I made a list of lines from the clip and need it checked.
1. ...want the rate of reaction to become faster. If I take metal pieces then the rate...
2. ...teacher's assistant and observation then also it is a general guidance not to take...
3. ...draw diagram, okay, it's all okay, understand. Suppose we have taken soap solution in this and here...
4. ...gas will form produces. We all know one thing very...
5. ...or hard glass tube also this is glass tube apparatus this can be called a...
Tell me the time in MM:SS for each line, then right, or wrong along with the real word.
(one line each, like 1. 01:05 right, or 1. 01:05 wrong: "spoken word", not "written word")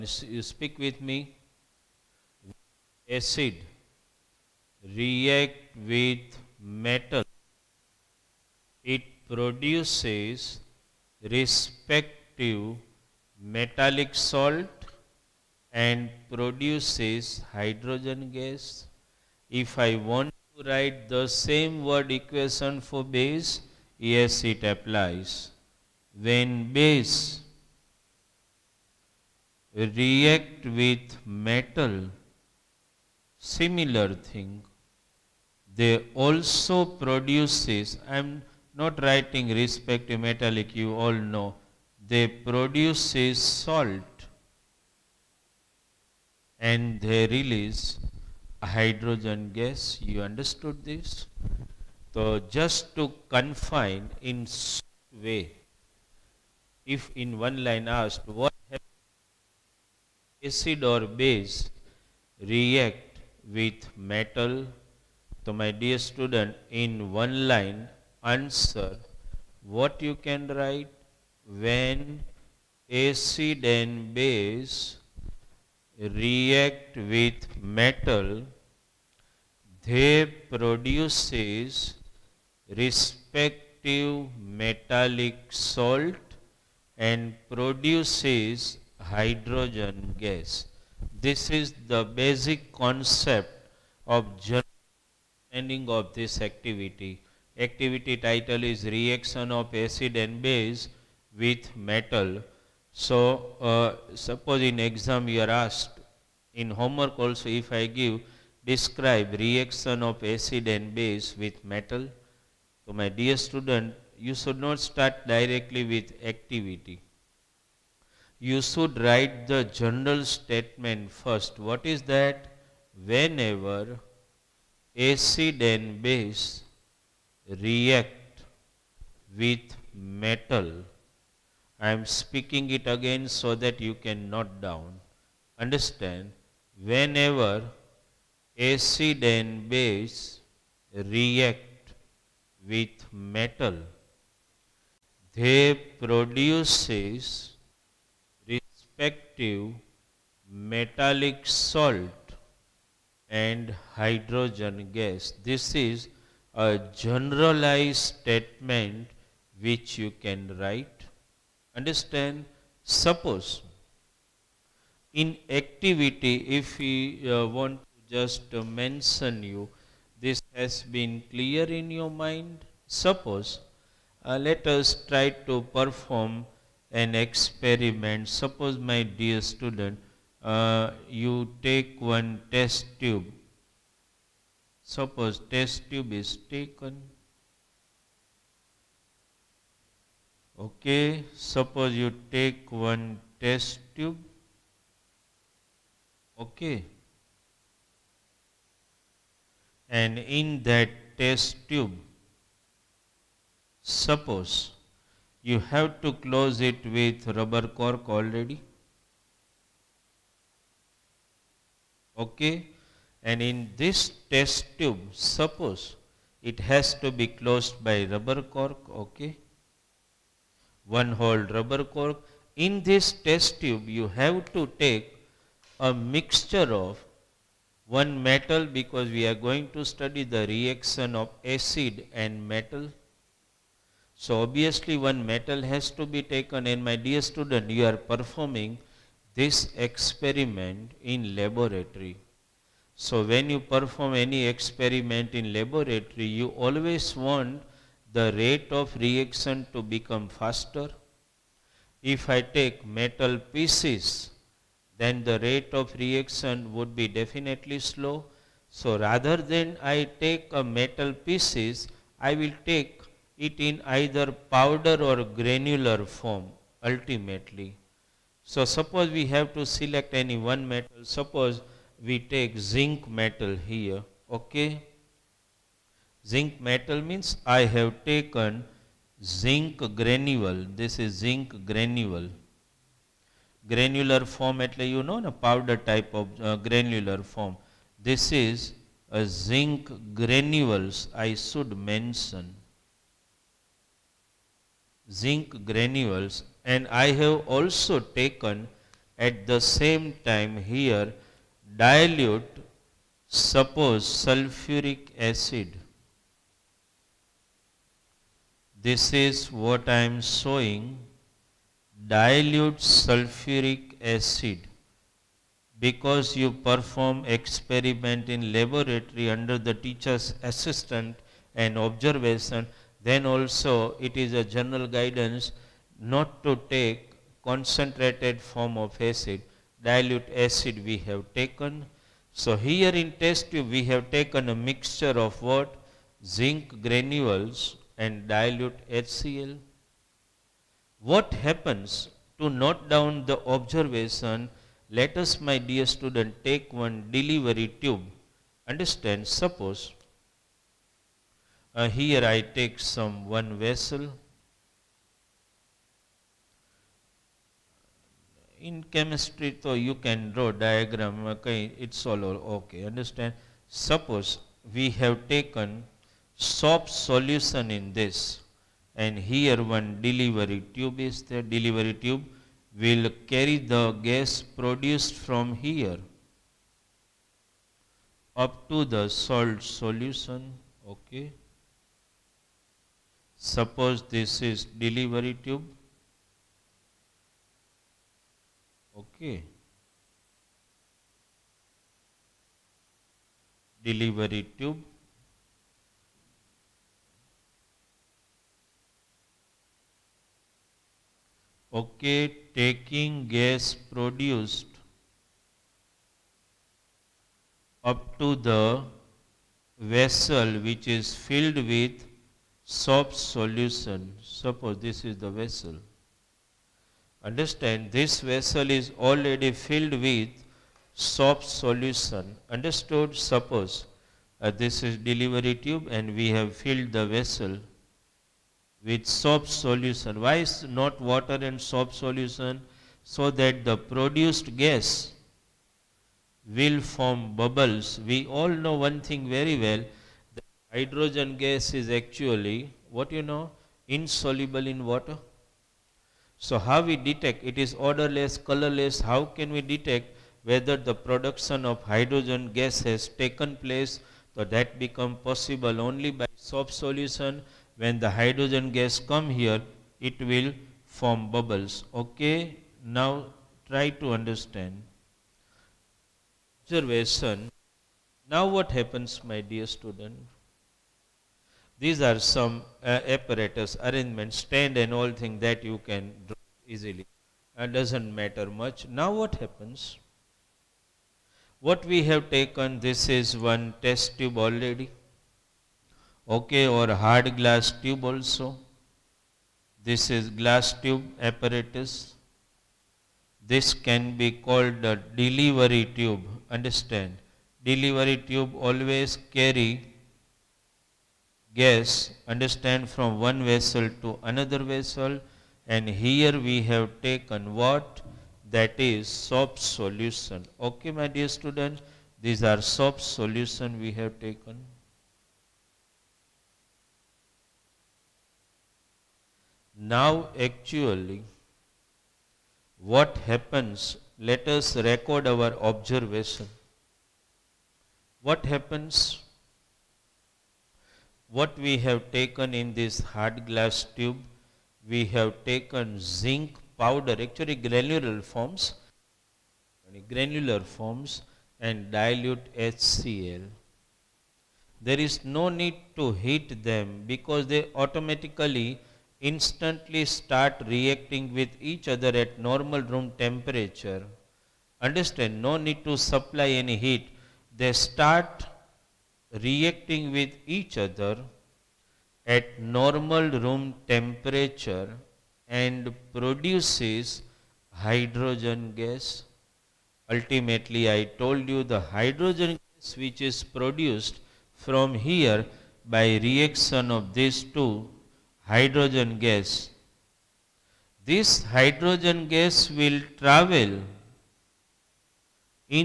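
1. 04:07 right
2. 05:19 right
3. 06:00 right
4. 07:14 wrong: "bubbles", not "produces"
5. 08:06 right.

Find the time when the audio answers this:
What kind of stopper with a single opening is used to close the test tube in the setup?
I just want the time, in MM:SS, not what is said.
03:40.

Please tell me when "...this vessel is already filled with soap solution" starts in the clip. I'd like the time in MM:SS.
06:57.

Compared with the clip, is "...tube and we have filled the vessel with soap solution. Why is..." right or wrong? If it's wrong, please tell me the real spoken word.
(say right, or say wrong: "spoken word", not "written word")
right.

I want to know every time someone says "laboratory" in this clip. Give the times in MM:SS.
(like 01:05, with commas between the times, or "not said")
04:01, 04:05, 05:18.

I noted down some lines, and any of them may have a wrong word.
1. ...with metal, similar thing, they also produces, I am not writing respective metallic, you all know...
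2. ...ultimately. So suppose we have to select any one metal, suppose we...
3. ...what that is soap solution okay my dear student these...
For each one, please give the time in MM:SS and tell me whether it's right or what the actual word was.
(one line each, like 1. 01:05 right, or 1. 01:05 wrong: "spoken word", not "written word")
1. 00:30 right
2. 04:26 right
3. 08:27 right.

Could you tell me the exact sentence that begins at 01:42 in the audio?
So, uh, suppose in exam you are asked, in homework also if I give, describe reaction of acid and base with metal.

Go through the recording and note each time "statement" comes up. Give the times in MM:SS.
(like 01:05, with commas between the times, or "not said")
02:00, 02:38.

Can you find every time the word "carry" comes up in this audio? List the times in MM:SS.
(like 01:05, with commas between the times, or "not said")
06:13, 08:19.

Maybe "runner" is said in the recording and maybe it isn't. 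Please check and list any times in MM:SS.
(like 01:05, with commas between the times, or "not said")
not said.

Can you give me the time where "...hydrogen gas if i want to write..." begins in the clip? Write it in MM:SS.
00:17.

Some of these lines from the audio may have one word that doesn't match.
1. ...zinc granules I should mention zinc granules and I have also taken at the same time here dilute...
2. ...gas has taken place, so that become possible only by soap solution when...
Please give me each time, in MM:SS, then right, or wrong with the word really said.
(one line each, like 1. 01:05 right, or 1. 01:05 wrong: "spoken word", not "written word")
1. 04:49 right
2. 07:32 right.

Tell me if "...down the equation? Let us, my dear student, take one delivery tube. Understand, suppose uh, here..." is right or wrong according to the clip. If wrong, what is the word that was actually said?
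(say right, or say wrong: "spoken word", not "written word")
wrong: "observation", not "equation".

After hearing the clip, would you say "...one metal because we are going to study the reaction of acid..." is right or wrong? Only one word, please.
right.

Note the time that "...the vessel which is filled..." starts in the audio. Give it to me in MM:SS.
06:48.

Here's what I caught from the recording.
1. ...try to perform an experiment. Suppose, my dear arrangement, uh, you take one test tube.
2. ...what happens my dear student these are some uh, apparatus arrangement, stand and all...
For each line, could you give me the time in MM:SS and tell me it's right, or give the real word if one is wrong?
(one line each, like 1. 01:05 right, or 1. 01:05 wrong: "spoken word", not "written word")
1. 02:55 wrong: "student", not "arrangement"
2. 07:48 right.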